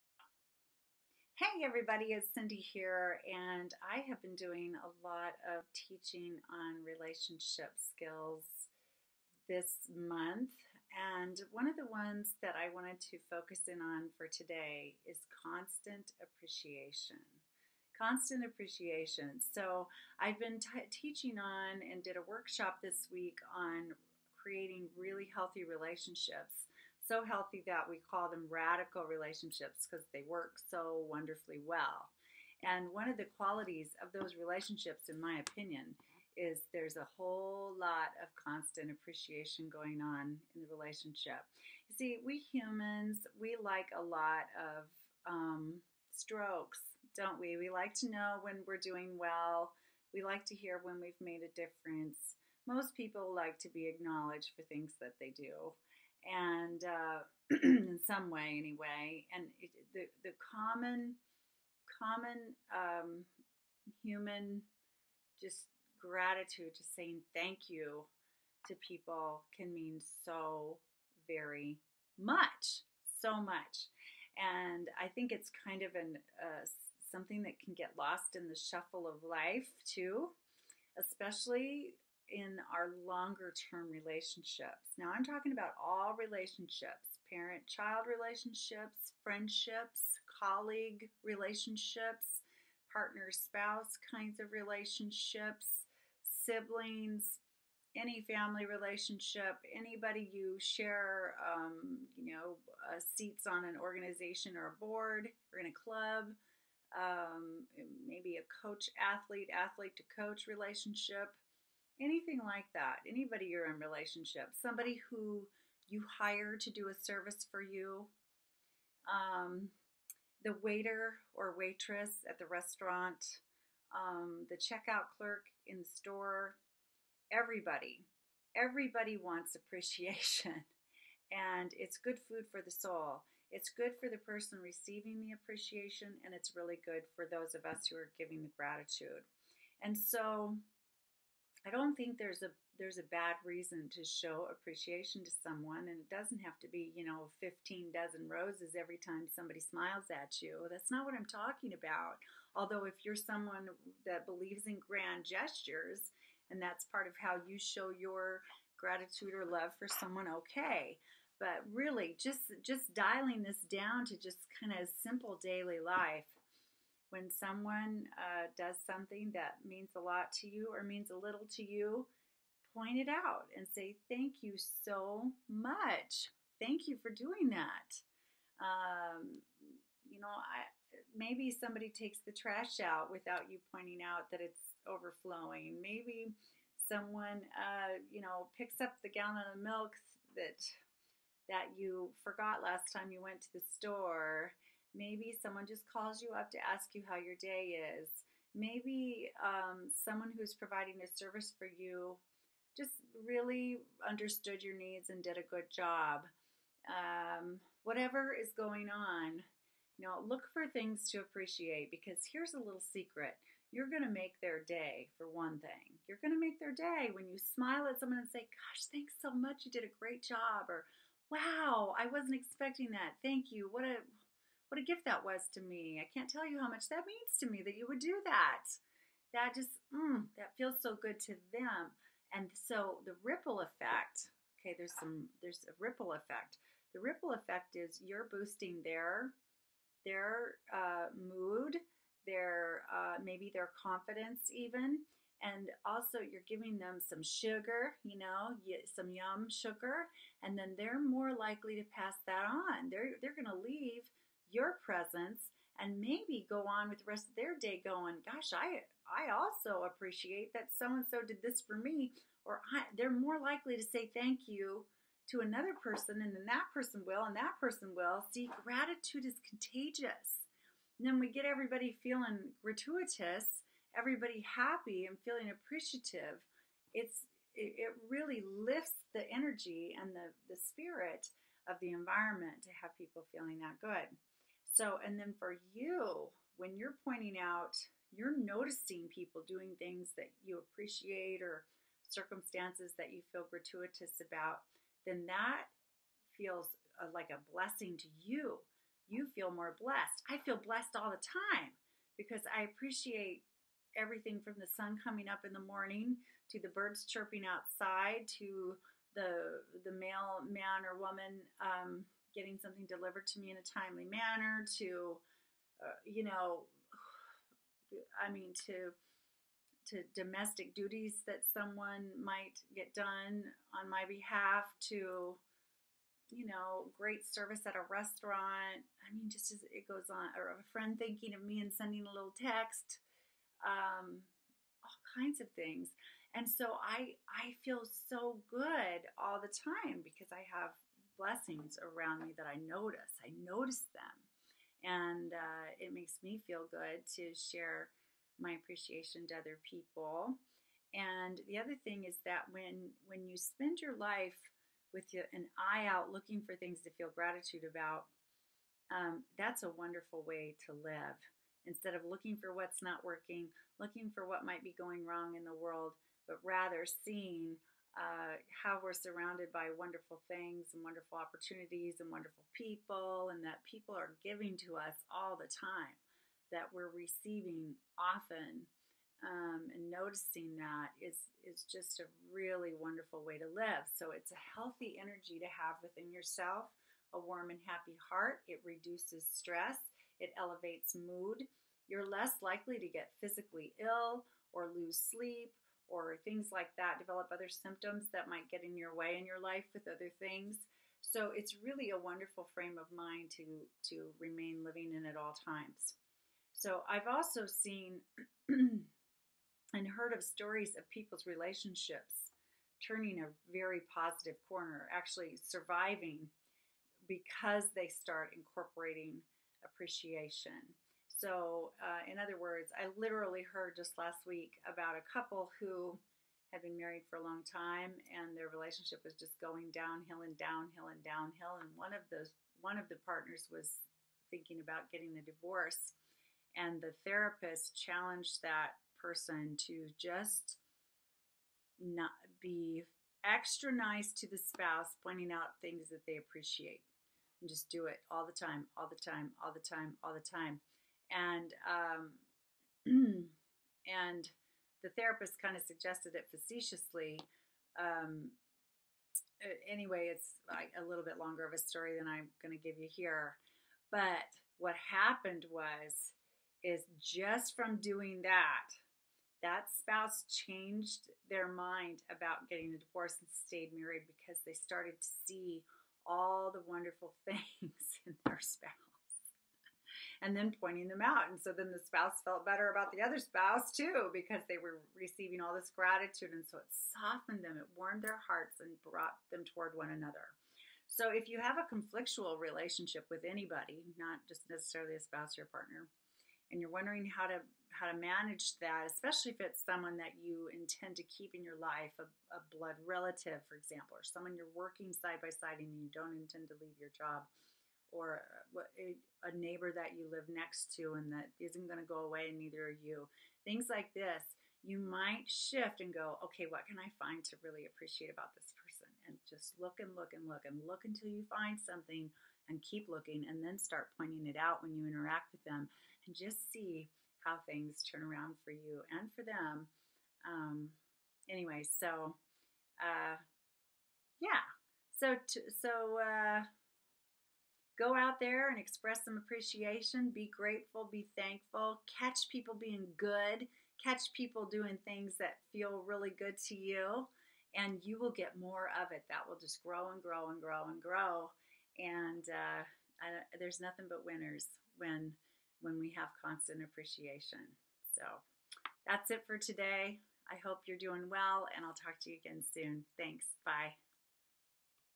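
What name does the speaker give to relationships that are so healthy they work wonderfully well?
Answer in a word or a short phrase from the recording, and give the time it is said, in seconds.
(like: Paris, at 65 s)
Radical relationships, at 28 s.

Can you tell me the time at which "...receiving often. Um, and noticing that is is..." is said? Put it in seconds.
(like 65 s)
376 s.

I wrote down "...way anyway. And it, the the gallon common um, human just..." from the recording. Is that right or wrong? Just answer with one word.
wrong.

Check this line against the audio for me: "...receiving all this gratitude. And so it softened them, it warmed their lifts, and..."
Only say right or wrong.
wrong.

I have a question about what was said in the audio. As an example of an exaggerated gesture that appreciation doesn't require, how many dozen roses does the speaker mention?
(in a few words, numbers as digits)
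15.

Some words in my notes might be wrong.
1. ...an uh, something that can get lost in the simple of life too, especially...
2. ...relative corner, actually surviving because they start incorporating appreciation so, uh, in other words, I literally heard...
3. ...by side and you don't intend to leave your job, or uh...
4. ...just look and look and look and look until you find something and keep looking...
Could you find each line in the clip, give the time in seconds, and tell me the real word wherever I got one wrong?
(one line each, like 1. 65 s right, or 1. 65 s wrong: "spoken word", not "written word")
1. 75 s wrong: "shuffle", not "simple"
2. 413 s wrong: "positive", not "relative"
3. 505 s right
4. 519 s right.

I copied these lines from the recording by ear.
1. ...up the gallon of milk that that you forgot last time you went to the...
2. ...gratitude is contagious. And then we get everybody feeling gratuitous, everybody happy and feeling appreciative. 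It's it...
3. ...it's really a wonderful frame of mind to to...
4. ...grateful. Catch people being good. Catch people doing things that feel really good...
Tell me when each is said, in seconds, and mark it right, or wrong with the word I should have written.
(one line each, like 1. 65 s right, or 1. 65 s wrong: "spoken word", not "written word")
1. 188 s right
2. 268 s right
3. 401 s right
4. 541 s wrong: "thankful", not "grateful".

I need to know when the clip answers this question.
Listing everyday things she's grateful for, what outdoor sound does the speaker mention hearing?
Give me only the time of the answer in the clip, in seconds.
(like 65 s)
306 s.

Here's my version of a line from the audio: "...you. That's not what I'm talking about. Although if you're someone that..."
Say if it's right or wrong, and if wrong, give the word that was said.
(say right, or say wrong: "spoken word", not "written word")
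right.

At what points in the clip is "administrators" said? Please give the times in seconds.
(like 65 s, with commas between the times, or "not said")
not said.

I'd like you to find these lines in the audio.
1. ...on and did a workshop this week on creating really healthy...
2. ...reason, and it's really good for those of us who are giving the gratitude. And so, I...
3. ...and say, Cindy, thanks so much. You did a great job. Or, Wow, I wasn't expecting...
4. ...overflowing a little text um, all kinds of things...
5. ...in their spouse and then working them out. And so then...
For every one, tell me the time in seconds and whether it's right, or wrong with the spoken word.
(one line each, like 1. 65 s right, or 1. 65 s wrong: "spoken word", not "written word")
1. 21 s right
2. 135 s wrong: "appreciation", not "reason"
3. 218 s wrong: "Gosh", not "Cindy"
4. 331 s wrong: "sending", not "overflowing"
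5. 478 s wrong: "pointing", not "working".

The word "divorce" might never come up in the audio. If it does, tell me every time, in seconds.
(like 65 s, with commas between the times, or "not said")
435 s, 472 s.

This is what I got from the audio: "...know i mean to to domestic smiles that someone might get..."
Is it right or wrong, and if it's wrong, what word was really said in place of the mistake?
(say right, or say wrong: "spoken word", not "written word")
wrong: "duties", not "smiles".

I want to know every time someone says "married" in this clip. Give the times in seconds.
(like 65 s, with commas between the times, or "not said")
426 s, 473 s.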